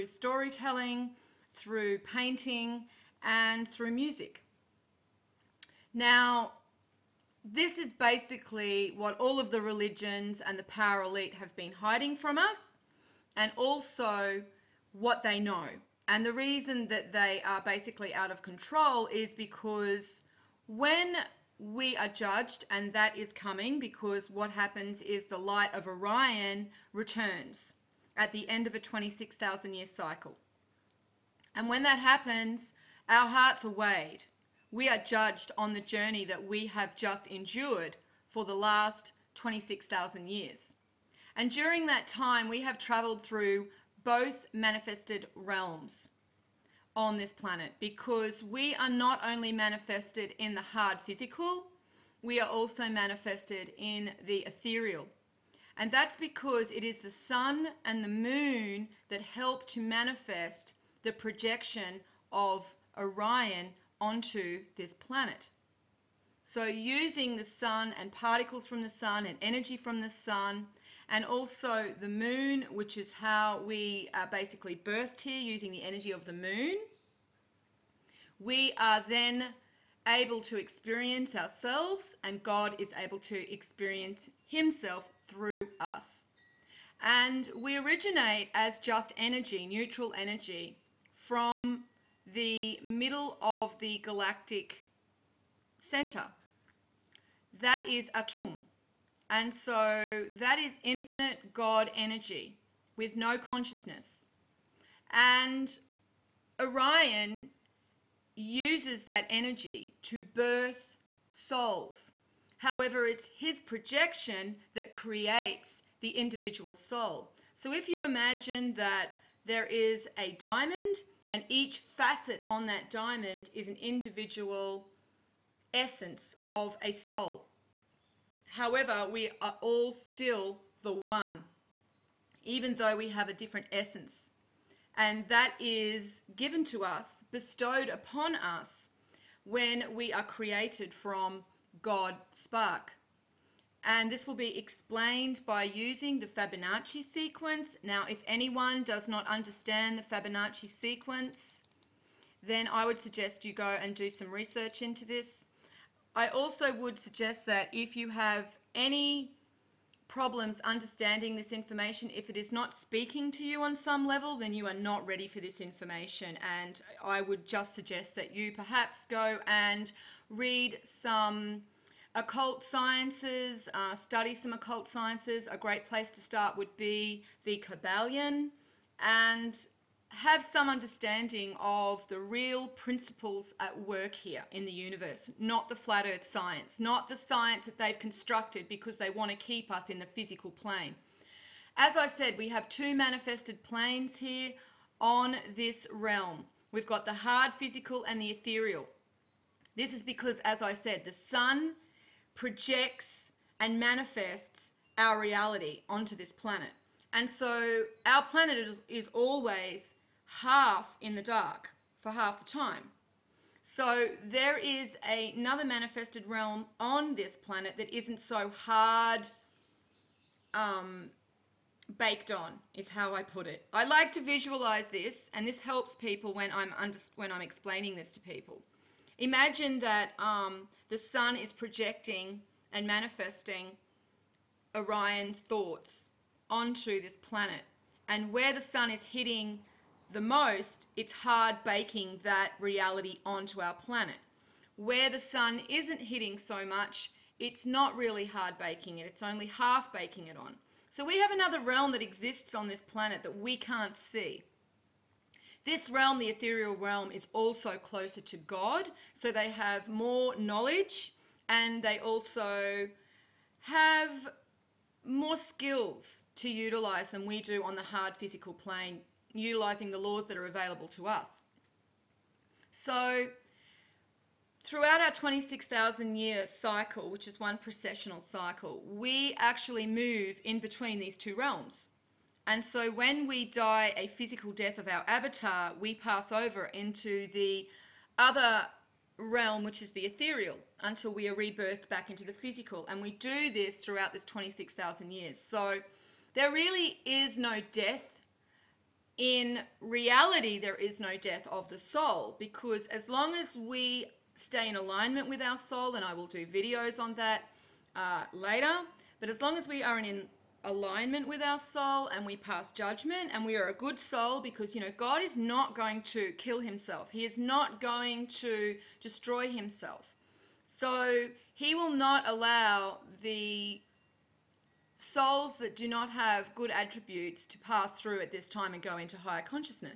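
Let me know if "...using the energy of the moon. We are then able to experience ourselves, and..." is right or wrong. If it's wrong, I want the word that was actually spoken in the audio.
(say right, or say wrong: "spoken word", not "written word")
right.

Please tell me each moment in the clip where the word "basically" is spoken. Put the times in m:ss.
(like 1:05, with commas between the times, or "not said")
0:07, 0:17, 1:14.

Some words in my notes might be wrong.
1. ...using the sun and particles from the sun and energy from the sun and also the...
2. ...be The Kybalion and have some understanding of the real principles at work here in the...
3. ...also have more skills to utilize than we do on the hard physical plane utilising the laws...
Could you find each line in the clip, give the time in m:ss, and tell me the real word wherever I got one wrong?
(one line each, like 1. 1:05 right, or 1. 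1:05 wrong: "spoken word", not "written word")
1. 1:06 right
2. 2:56 right
3. 4:21 right.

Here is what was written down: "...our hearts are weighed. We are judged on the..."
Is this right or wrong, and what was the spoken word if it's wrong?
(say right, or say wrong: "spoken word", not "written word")
right.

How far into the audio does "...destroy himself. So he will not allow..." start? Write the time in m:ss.
5:19.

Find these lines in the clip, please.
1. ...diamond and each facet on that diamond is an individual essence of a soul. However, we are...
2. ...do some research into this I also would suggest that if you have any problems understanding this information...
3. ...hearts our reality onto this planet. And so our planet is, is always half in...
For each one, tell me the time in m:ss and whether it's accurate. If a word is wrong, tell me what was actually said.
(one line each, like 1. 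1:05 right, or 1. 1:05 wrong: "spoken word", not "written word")
1. 2:00 right
2. 2:33 right
3. 3:23 wrong: "manifests", not "hearts".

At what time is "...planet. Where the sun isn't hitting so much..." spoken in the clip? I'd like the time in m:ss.
4:03.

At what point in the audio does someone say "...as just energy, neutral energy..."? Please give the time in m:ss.
1:28.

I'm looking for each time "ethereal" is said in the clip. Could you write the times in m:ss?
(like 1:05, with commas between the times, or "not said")
0:54, 3:18, 4:16, 4:50.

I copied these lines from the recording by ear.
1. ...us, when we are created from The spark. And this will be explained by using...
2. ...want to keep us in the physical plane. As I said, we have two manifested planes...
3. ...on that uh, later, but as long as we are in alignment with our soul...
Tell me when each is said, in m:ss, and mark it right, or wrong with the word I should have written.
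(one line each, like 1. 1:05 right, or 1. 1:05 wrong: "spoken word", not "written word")
1. 2:18 wrong: "God", not "The"
2. 3:09 right
3. 5:06 right.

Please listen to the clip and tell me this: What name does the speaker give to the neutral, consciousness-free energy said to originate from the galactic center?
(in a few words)
Atum.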